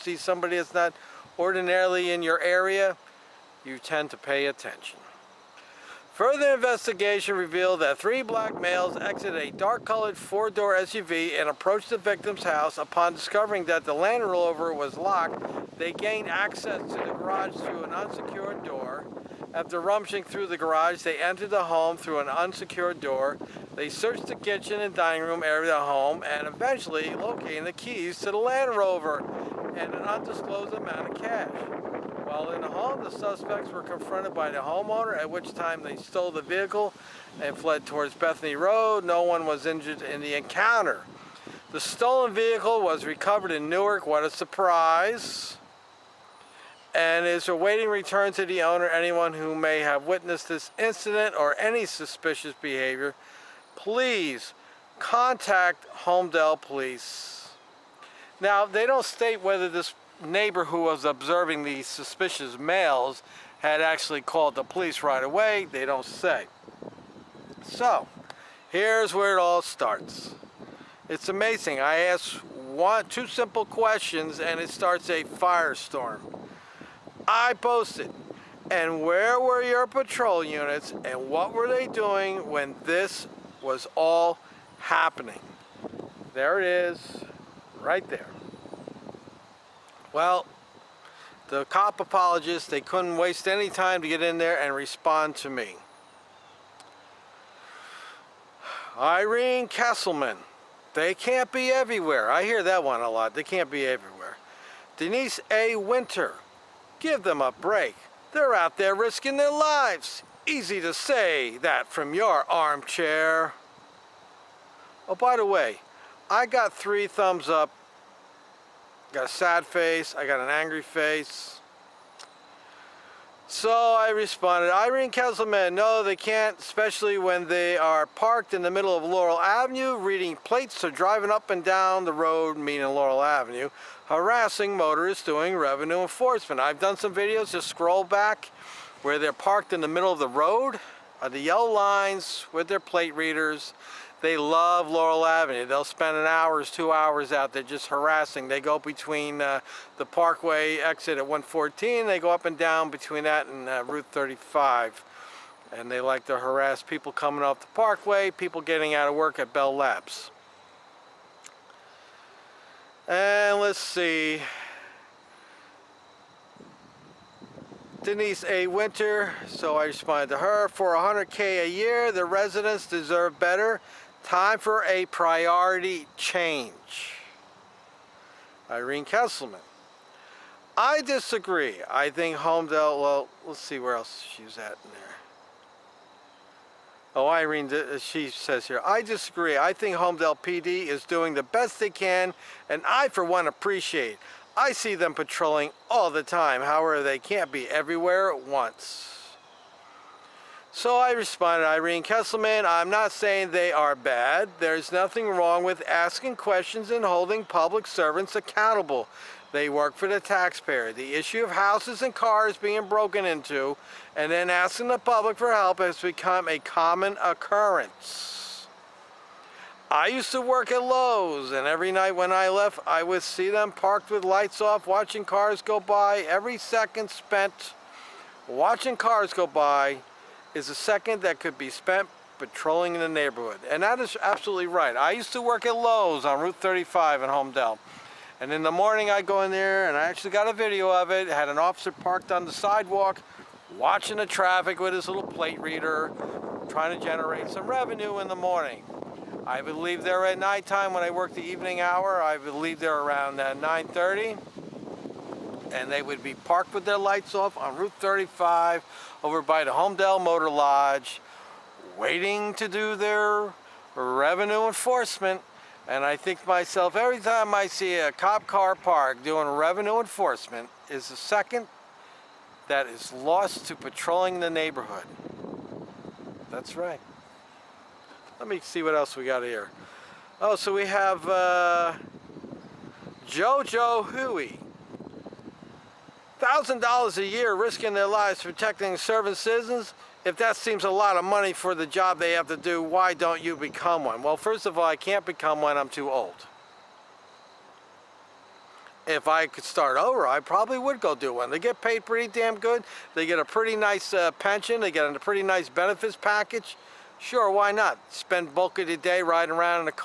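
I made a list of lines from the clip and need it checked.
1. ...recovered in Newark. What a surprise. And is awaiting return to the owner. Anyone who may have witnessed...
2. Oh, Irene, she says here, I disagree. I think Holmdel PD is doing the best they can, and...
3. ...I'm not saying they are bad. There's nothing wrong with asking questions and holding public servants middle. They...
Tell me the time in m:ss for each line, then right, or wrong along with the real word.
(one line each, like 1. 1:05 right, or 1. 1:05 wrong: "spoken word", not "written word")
1. 0:43 right
2. 3:07 right
3. 3:22 wrong: "accountable", not "middle".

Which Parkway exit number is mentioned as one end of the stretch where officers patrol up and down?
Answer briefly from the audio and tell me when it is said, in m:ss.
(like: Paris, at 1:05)
114, at 2:31.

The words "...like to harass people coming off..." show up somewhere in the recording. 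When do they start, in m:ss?
2:36.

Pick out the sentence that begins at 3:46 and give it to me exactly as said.
Every second spent watching cars go by is a second that could be spent patrolling in the neighborhood.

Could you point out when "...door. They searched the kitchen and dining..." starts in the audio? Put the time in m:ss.
0:22.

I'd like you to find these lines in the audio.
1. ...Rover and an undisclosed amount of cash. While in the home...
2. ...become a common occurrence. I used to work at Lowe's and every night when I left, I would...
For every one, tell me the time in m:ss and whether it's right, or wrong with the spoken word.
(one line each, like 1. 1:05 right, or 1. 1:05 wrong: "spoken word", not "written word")
1. 0:28 right
2. 3:35 right.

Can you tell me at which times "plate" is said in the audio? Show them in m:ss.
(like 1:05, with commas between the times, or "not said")
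2:10, 2:22, 4:05.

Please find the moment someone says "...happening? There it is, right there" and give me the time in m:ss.
1:24.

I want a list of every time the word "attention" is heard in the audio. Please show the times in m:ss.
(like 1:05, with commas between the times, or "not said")
0:04.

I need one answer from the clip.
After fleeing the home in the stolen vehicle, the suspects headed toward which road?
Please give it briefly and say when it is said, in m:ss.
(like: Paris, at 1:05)
Bethany Road, at 0:38.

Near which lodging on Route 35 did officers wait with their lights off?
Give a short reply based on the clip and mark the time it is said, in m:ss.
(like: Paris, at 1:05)
Holmdel Motor Lodge, at 4:19.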